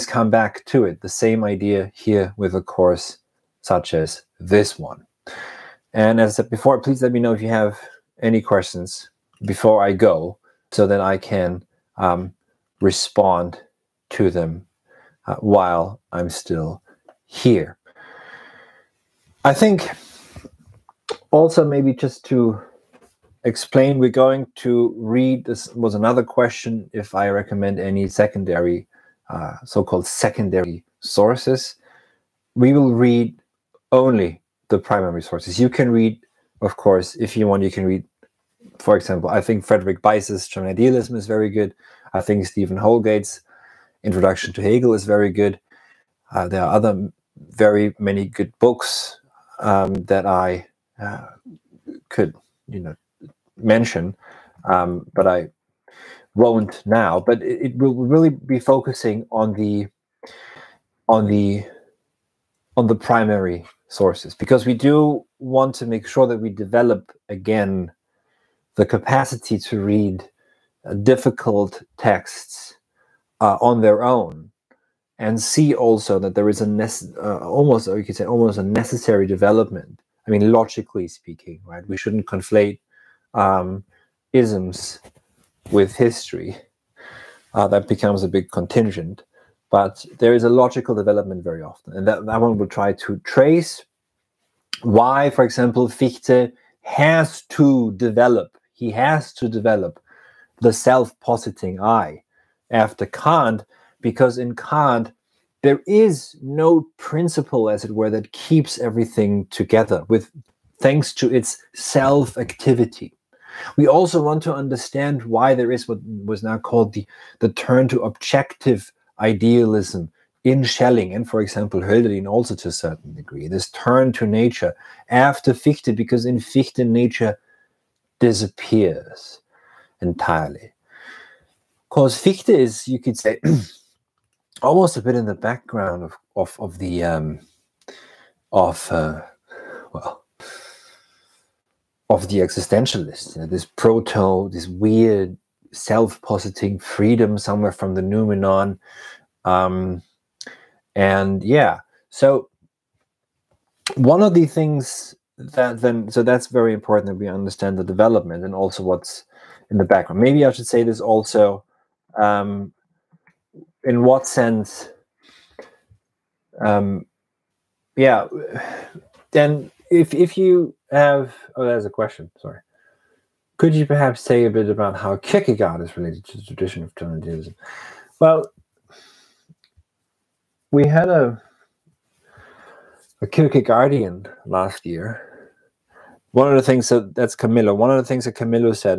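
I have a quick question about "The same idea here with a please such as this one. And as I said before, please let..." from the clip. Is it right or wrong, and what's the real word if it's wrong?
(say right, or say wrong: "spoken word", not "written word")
wrong: "course", not "please".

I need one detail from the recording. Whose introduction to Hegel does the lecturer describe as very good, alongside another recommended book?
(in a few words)
Stephen Houlgate.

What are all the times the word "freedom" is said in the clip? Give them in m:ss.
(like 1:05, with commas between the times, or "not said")
2:26.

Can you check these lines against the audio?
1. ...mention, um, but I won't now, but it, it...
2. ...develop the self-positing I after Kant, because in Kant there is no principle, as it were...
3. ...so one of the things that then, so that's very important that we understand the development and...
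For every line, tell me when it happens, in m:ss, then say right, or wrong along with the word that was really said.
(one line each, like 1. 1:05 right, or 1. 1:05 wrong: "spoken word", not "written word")
1. 0:53 right
2. 1:39 right
3. 2:32 right.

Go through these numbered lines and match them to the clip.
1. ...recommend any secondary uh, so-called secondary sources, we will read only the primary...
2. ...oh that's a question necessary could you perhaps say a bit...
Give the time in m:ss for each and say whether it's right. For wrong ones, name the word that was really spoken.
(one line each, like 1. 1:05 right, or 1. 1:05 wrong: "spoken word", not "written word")
1. 0:27 right
2. 2:51 wrong: "sorry", not "necessary".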